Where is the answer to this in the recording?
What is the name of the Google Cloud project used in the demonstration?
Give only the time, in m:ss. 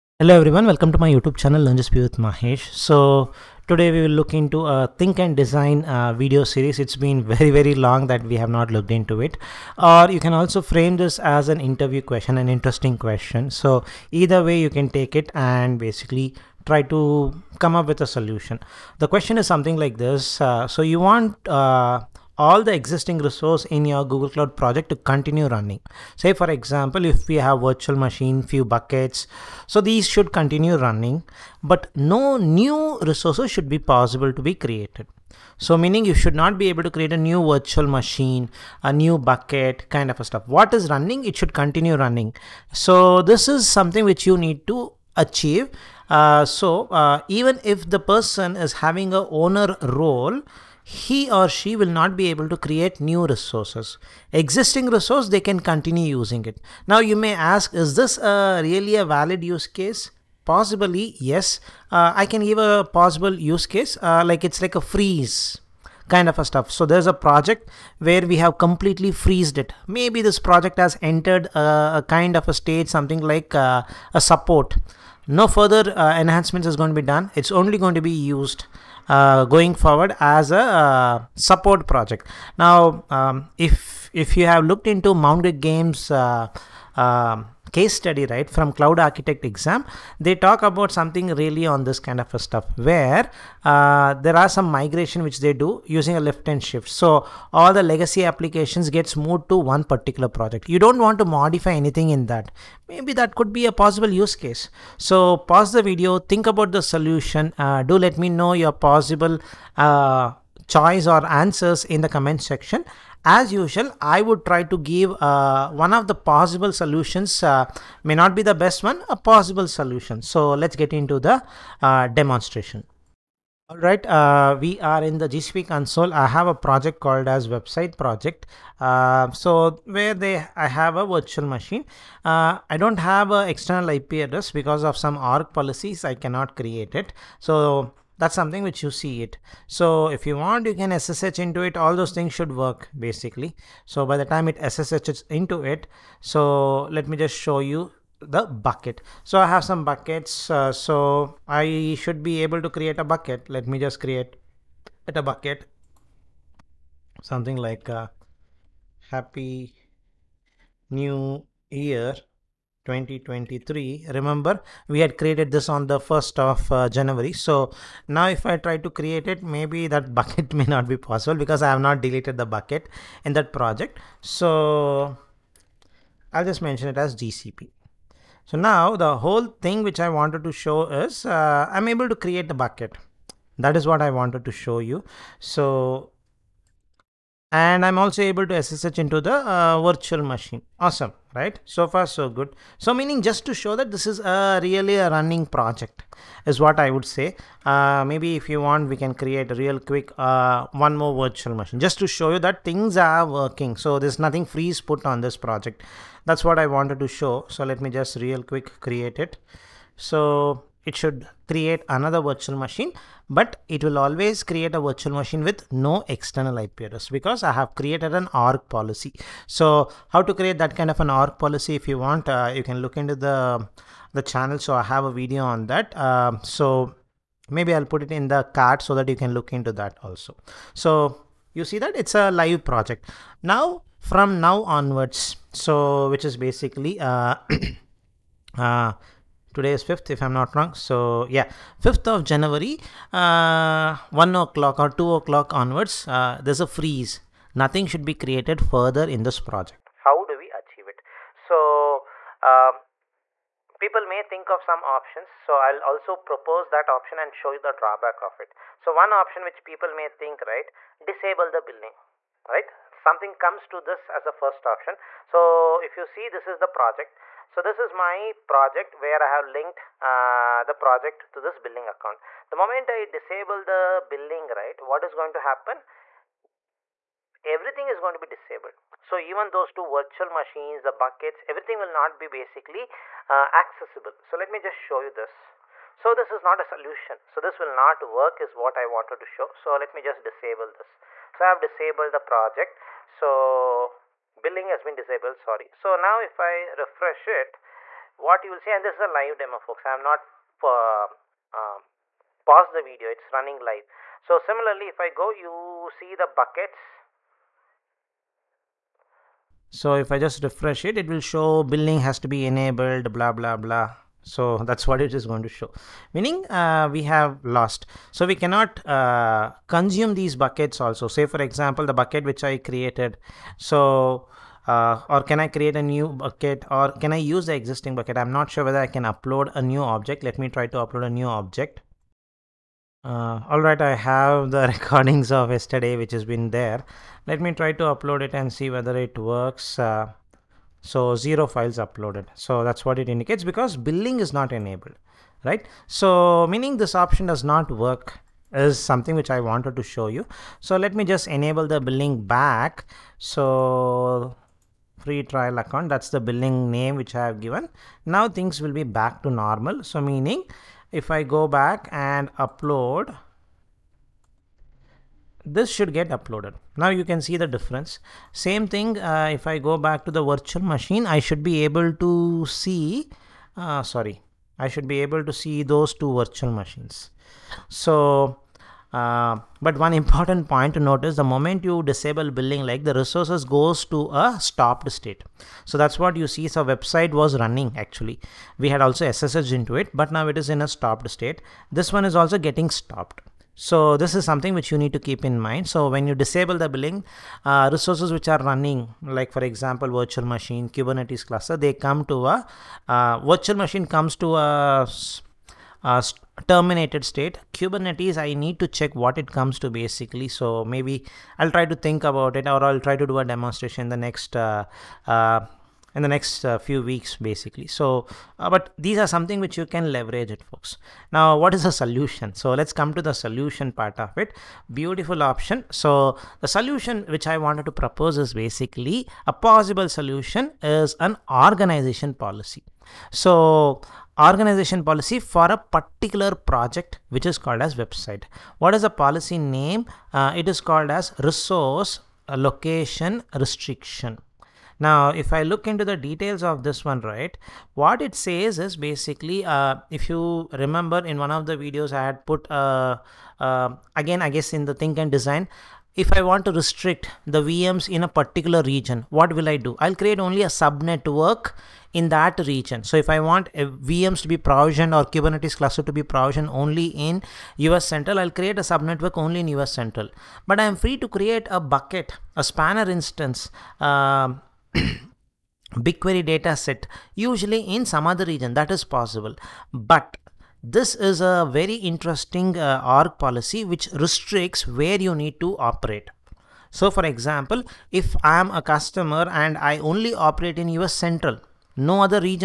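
2:07.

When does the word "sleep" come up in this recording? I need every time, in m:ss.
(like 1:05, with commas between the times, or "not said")
not said.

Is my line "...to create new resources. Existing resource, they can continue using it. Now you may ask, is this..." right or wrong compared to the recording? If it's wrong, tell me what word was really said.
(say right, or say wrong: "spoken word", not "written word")
right.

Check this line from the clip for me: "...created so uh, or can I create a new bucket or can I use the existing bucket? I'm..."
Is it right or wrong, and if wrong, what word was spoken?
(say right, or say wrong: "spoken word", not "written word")
right.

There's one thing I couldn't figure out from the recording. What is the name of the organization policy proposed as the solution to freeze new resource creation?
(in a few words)
resource location restriction.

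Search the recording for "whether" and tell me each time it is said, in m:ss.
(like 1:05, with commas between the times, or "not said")
5:28, 5:38.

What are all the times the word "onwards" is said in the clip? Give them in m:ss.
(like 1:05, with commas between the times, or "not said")
3:54, 4:05.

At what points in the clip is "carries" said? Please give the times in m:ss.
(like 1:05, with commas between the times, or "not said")
not said.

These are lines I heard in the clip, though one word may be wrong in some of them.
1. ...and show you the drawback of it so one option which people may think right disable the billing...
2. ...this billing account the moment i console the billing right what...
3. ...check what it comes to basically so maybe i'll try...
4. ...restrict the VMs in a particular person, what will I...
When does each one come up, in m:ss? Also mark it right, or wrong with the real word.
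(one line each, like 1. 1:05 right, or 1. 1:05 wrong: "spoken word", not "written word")
1. 4:17 right
2. 4:31 wrong: "disable", not "console"
3. 6:48 right
4. 7:36 wrong: "region", not "person".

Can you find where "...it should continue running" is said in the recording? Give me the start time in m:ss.
0:41.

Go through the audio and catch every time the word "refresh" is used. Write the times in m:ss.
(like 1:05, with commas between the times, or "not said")
4:56, 5:10.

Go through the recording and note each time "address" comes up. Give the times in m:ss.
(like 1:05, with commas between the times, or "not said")
2:14, 3:36.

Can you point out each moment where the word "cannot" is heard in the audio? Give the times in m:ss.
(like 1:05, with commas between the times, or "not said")
2:16, 5:18.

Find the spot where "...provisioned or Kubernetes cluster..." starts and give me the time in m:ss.
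7:44.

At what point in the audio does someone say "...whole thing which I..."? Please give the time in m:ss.
2:59.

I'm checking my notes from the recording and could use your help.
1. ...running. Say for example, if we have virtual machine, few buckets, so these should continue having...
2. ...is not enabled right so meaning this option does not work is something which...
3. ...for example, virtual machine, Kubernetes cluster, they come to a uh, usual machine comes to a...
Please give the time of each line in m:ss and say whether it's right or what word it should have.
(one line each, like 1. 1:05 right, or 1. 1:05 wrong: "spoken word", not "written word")
1. 0:25 wrong: "running", not "having"
2. 5:44 right
3. 6:39 wrong: "virtual", not "usual".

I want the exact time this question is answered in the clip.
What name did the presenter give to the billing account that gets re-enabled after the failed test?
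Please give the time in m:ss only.
5:54.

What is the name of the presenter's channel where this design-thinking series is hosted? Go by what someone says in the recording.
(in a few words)
LearnGCP with Mahesh.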